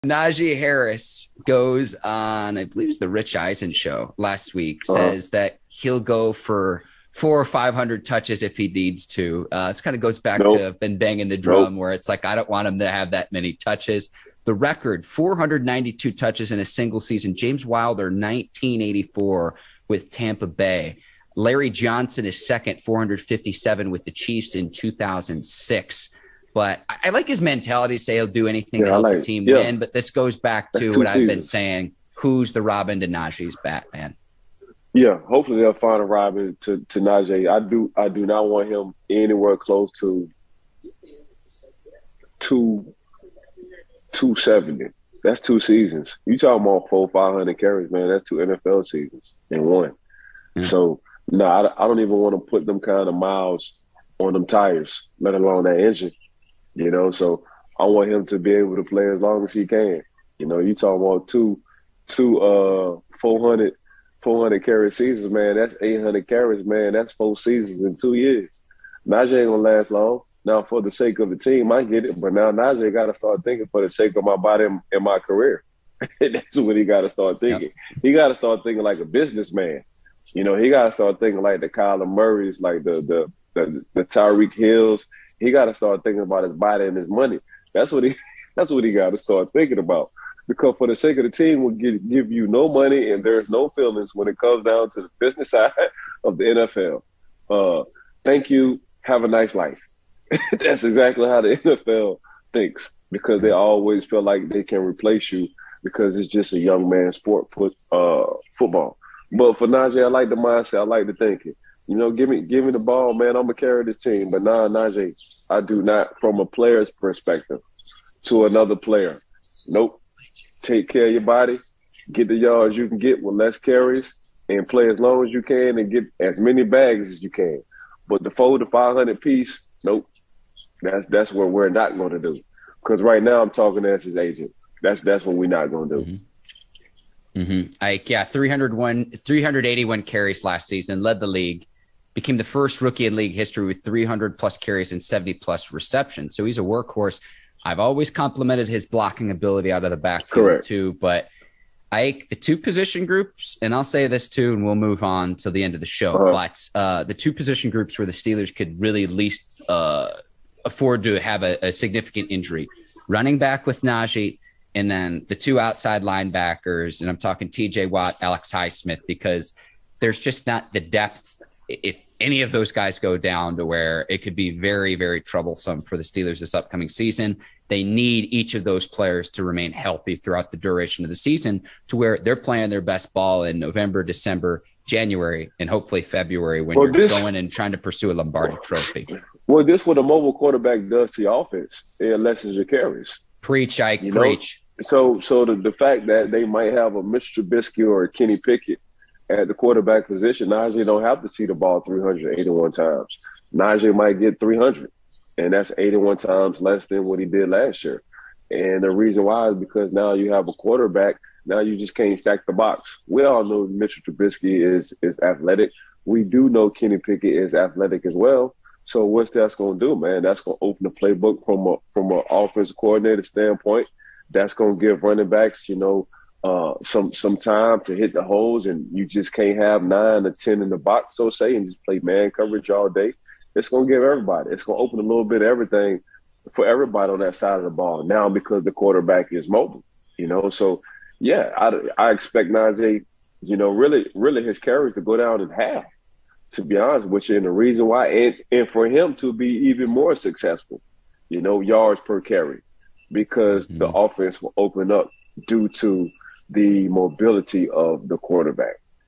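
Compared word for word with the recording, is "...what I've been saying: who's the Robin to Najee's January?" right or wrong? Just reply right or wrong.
wrong.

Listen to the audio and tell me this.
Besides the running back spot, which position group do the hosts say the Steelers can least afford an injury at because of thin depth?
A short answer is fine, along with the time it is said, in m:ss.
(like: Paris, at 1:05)
Outside linebackers, at 2:45.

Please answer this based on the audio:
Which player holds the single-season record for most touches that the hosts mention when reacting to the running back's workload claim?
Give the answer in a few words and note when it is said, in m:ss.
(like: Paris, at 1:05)
James Wilder, at 0:17.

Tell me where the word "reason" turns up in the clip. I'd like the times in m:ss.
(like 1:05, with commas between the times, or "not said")
3:28, 4:07.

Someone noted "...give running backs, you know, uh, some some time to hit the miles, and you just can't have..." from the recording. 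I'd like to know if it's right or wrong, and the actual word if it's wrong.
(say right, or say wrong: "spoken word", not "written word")
wrong: "holes", not "miles".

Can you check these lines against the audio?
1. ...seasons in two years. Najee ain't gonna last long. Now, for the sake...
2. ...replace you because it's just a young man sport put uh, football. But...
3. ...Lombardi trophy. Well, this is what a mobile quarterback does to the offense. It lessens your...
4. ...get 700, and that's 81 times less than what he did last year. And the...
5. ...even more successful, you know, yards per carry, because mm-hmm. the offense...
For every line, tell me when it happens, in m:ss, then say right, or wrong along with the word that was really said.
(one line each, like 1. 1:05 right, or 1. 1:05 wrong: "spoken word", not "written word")
1. 1:07 right
2. 1:44 right
3. 3:08 right
4. 3:24 wrong: "300", not "700"
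5. 4:09 right.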